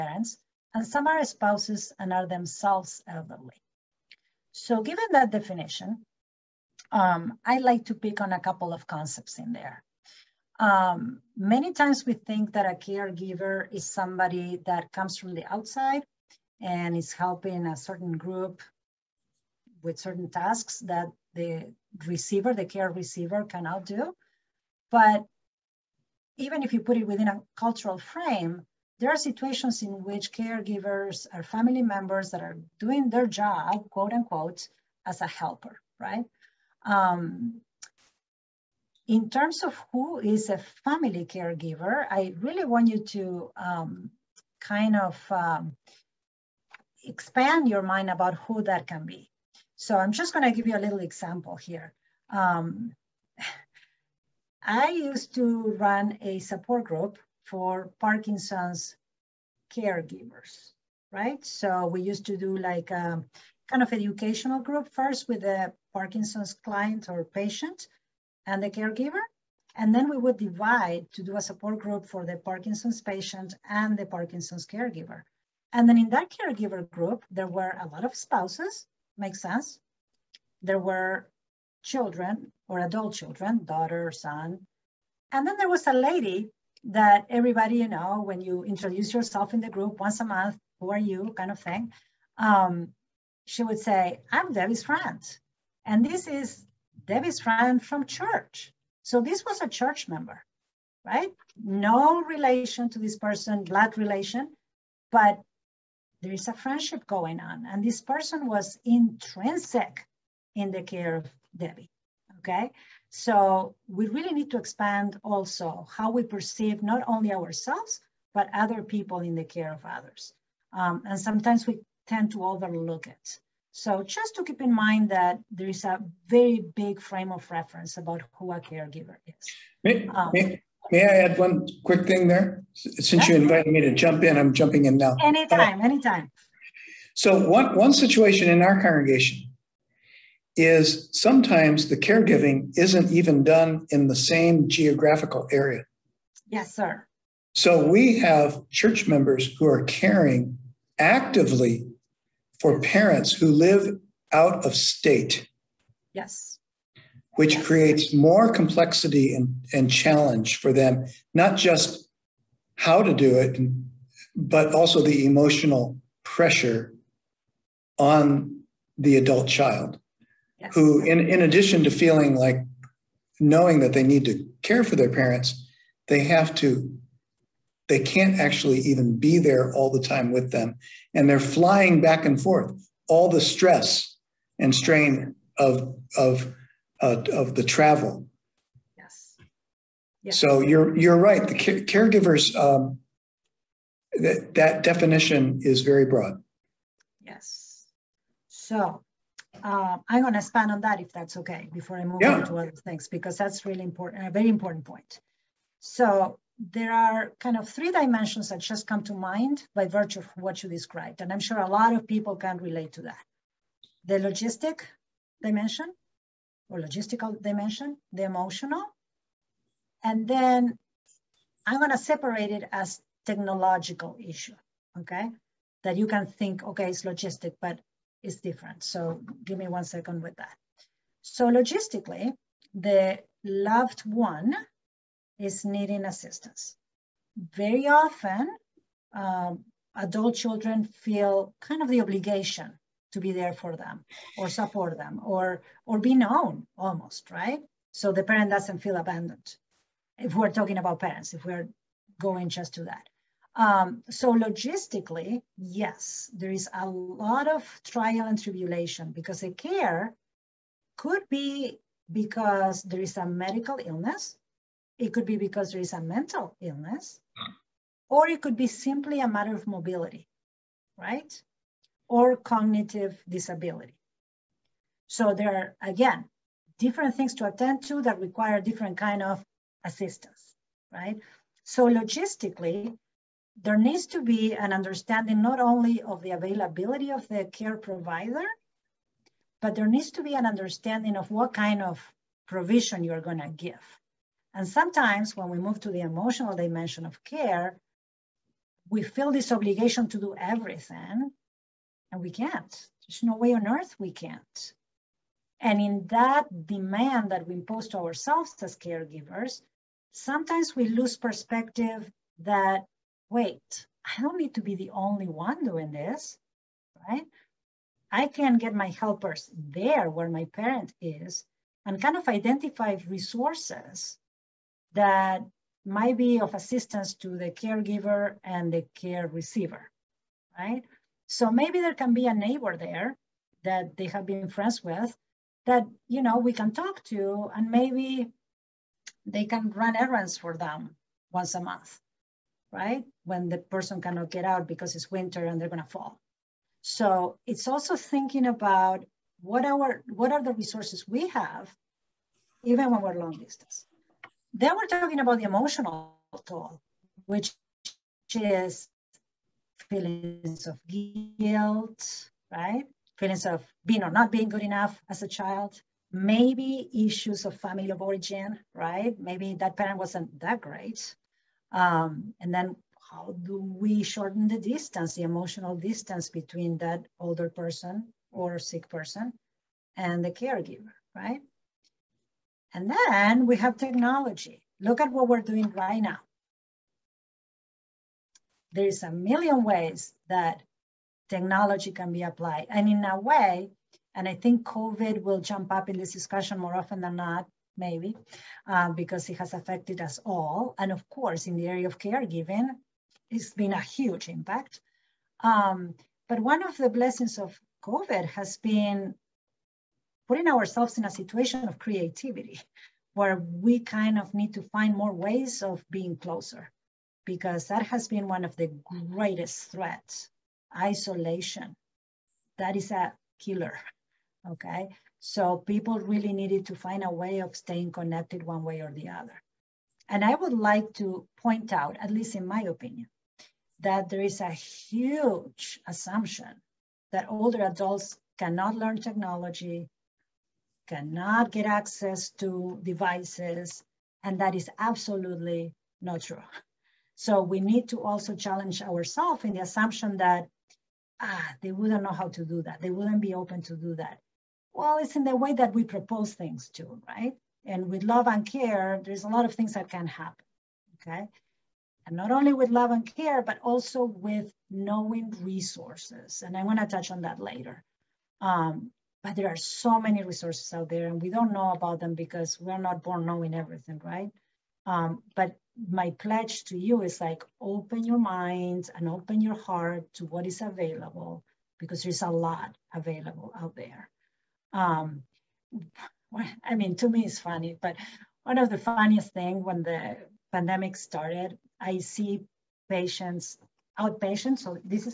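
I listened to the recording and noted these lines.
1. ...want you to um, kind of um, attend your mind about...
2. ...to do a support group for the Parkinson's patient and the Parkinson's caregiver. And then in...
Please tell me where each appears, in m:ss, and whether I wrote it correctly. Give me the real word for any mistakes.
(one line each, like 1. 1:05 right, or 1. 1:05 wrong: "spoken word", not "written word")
1. 0:42 wrong: "expand", not "attend"
2. 1:11 right.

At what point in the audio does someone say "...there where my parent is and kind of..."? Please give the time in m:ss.
5:19.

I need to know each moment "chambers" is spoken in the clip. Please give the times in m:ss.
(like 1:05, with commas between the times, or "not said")
not said.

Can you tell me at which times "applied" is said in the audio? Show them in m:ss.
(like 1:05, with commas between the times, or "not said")
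6:32.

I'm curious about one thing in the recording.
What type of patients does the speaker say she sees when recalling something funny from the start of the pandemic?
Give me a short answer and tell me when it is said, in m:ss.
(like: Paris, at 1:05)
outpatients, at 8:13.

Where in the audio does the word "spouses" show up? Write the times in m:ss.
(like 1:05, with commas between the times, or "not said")
0:01, 1:18.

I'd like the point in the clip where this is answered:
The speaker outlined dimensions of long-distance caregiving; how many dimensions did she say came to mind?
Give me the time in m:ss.
3:27.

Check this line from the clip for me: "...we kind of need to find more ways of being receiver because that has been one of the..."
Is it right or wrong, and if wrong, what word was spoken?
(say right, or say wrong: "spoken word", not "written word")
wrong: "closer", not "receiver".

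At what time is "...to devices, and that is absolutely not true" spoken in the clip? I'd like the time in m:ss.
7:22.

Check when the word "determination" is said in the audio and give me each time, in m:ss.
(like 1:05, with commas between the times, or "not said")
not said.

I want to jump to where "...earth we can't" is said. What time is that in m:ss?
5:03.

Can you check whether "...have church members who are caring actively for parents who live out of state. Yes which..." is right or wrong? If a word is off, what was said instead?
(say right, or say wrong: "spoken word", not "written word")
right.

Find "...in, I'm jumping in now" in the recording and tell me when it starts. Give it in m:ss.
2:14.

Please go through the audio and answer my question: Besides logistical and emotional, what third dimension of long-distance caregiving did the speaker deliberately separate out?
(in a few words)
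technological.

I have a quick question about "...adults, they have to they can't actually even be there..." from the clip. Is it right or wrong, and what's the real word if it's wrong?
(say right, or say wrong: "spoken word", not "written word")
wrong: "parents", not "adults".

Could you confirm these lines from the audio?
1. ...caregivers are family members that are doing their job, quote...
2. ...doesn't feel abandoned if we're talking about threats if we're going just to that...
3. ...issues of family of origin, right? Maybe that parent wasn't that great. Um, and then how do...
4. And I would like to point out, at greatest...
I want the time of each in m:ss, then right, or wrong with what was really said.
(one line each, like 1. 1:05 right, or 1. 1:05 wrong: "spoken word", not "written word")
1. 0:30 right
2. 4:08 wrong: "parents", not "threats"
3. 6:06 right
4. 7:10 wrong: "least", not "greatest".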